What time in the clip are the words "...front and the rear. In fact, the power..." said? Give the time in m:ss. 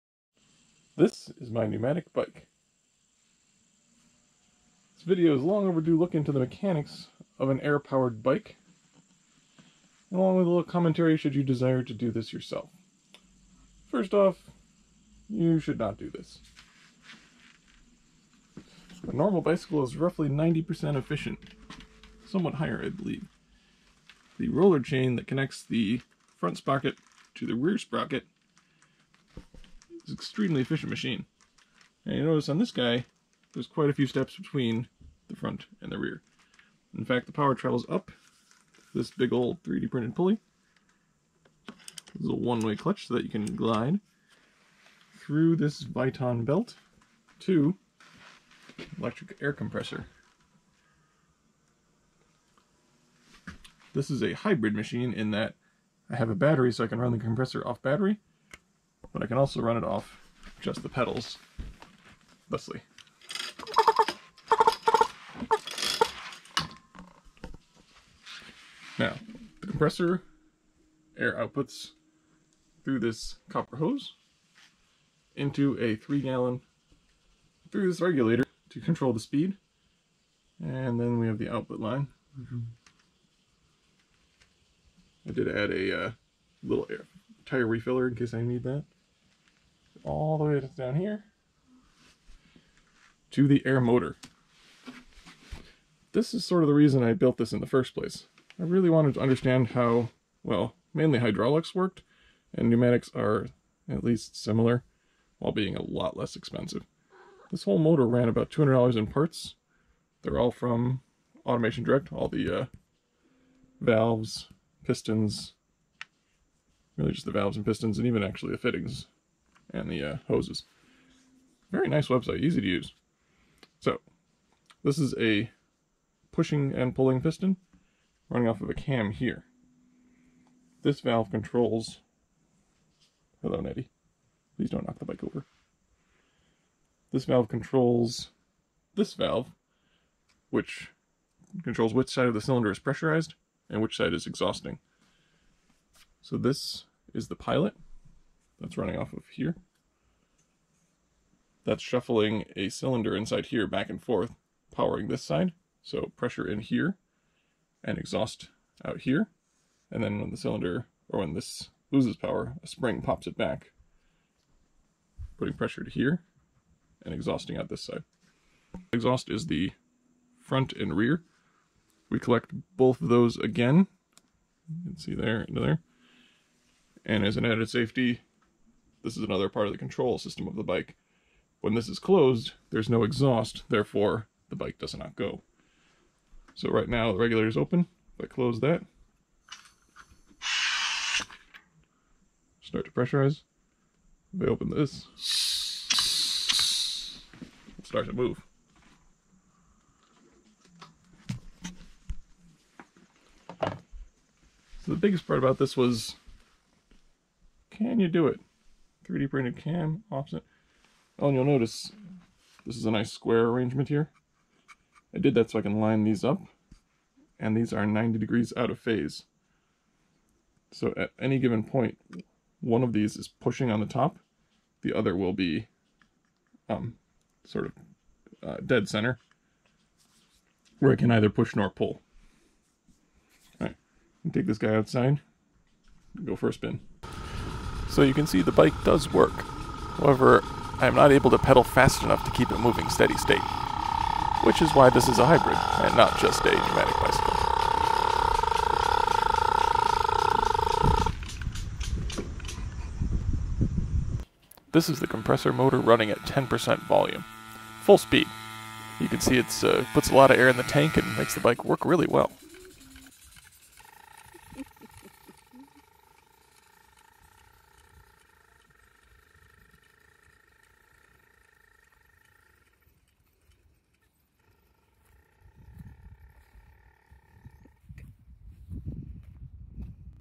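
0:35.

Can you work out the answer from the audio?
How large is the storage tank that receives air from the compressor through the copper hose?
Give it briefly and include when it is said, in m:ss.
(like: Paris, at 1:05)
3 gallon, at 1:15.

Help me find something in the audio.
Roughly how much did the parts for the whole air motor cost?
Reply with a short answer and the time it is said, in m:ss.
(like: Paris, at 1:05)
$200, at 1:48.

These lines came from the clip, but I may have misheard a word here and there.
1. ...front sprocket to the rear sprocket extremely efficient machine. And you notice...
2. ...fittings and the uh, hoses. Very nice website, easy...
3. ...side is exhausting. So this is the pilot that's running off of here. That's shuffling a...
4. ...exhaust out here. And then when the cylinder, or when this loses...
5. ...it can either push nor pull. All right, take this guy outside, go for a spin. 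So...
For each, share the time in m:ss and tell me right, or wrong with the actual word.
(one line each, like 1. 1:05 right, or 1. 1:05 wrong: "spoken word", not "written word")
1. 0:26 right
2. 1:58 right
3. 2:23 right
4. 2:37 right
5. 3:50 right.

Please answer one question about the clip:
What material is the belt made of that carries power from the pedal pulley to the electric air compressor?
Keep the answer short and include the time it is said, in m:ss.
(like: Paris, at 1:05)
Viton, at 0:45.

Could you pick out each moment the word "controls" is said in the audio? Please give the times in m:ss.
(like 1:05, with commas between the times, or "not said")
1:18, 2:11, 2:17, 2:21, 2:59.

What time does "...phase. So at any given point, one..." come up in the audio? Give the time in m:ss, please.
3:38.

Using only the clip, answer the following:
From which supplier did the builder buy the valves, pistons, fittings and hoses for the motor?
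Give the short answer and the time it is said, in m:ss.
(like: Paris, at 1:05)
Automation Direct, at 1:51.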